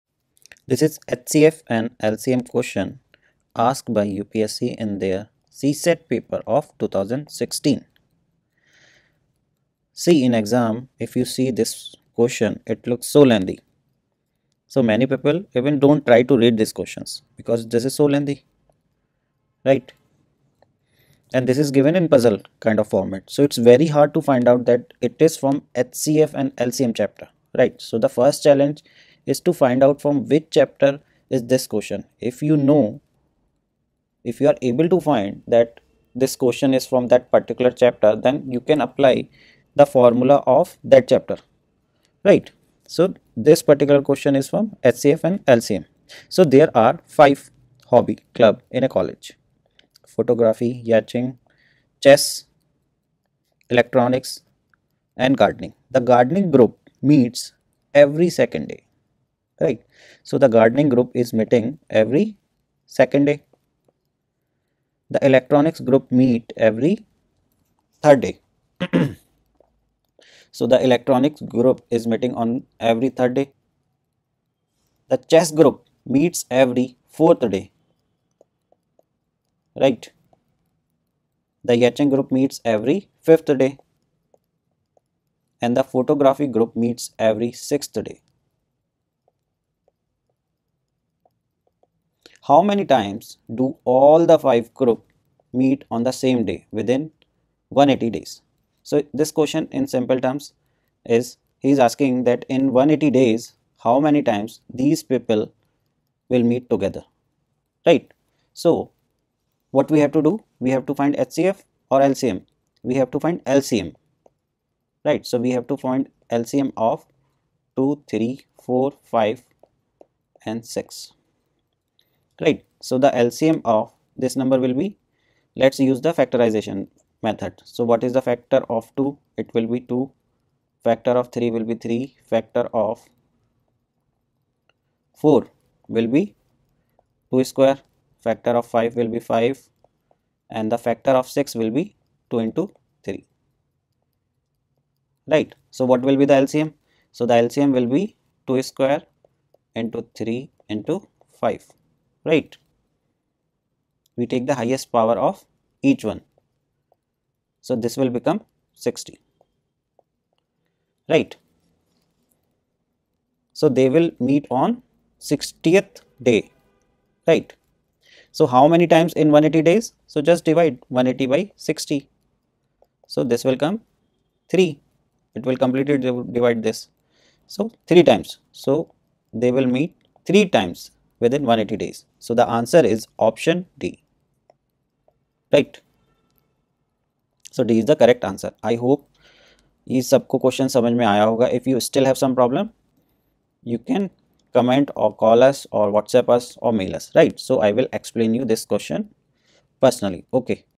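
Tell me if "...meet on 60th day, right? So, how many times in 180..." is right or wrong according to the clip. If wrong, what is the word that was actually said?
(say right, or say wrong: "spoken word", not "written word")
right.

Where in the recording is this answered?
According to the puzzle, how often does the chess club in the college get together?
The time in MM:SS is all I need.
01:16.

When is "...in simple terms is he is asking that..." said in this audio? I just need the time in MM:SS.
01:39.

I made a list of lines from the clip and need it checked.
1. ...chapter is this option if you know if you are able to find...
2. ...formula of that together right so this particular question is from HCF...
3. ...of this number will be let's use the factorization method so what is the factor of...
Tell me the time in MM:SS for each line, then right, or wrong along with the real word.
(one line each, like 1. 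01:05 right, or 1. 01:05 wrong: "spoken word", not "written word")
1. 00:30 wrong: "question", not "option"
2. 00:39 wrong: "chapter", not "together"
3. 02:03 right.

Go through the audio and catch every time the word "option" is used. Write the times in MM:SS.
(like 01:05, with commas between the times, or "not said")
03:03.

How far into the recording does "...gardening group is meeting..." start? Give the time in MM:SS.
01:00.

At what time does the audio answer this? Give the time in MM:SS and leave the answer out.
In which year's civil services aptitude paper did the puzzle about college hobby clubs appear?
00:06.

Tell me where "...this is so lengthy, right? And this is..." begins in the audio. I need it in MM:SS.
00:17.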